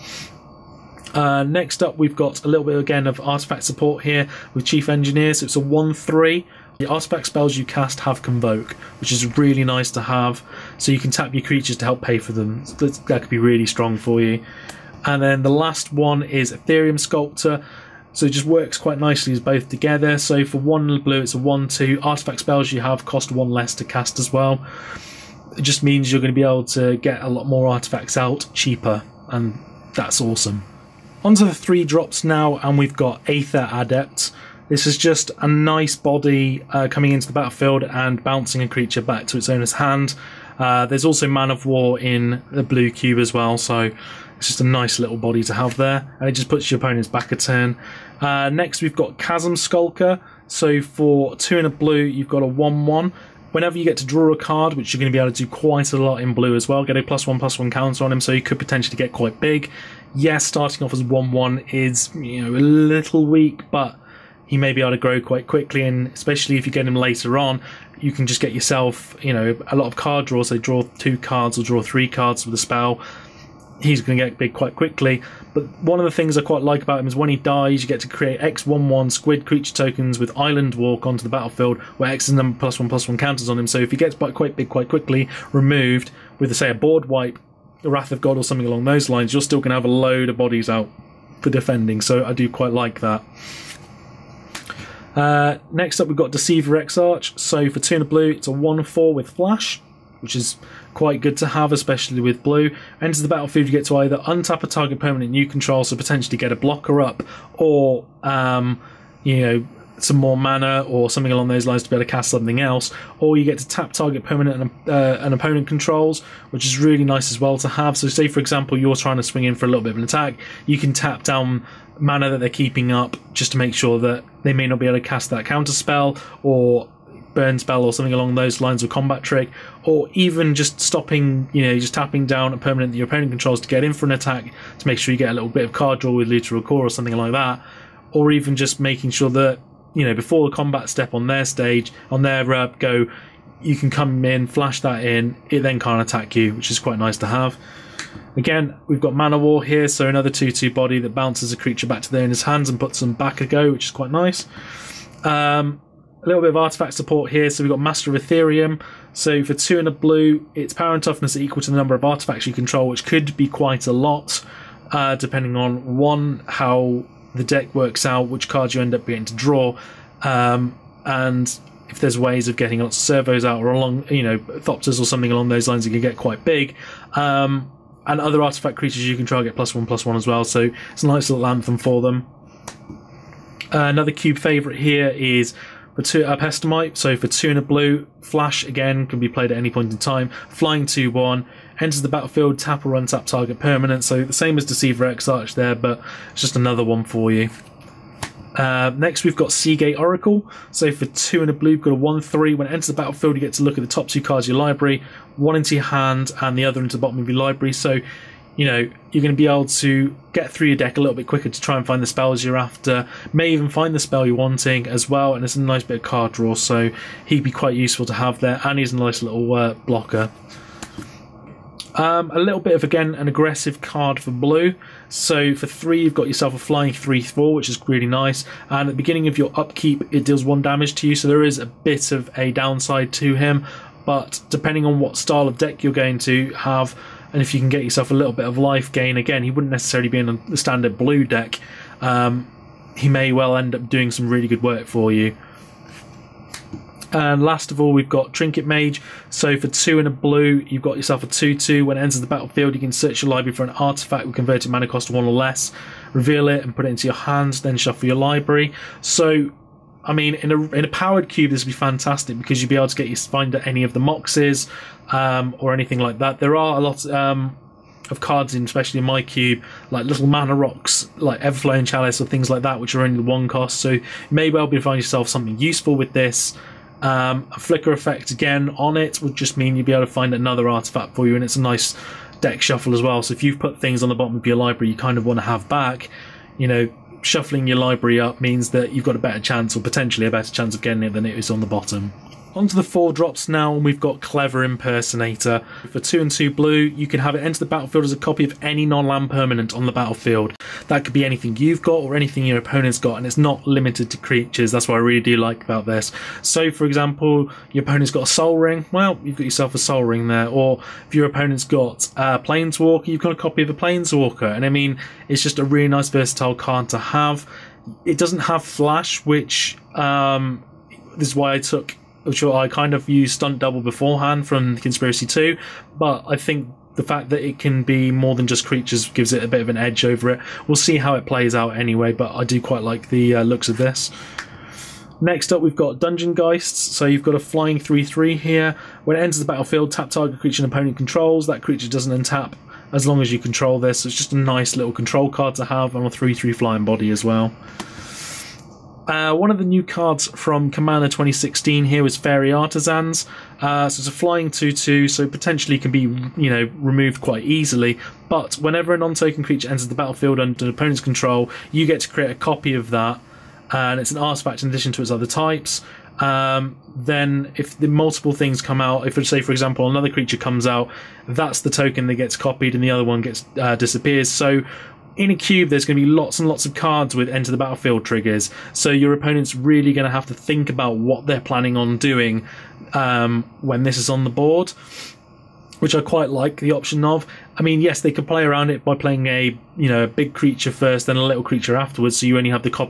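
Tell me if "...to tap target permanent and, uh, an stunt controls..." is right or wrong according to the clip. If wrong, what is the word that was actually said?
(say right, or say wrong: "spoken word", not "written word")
wrong: "opponent", not "stunt".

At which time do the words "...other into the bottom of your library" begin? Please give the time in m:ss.
3:26.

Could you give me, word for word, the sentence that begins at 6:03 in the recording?
And it's an artifact in addition to its other types.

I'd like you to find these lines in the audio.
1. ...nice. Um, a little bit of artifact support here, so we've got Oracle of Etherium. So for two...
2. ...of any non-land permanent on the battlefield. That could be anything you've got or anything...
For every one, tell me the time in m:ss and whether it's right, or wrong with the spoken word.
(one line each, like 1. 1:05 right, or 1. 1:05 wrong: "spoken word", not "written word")
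1. 2:34 wrong: "Master", not "Oracle"
2. 4:58 right.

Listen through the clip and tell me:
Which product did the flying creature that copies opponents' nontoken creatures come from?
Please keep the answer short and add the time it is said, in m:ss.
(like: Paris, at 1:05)
Commander 2016, at 5:50.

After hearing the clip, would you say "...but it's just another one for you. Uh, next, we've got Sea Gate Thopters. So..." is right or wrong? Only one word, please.
wrong.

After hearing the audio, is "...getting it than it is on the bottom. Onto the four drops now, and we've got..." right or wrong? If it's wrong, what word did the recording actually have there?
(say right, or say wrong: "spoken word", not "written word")
right.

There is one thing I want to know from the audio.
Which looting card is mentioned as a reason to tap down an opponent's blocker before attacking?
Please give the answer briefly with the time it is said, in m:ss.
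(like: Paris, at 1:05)
Looter il-Kor, at 2:16.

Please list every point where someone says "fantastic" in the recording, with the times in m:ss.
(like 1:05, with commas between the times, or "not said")
4:21.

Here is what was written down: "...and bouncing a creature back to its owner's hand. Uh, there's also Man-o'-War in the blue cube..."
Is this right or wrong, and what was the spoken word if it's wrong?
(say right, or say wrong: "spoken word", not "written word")
right.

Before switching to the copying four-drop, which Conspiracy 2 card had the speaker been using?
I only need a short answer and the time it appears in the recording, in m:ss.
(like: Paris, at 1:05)
Stunt Double, at 5:23.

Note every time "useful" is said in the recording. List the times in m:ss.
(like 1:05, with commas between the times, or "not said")
3:37, 4:35.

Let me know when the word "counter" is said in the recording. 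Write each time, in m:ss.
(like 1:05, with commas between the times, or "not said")
0:57, 1:23, 2:05.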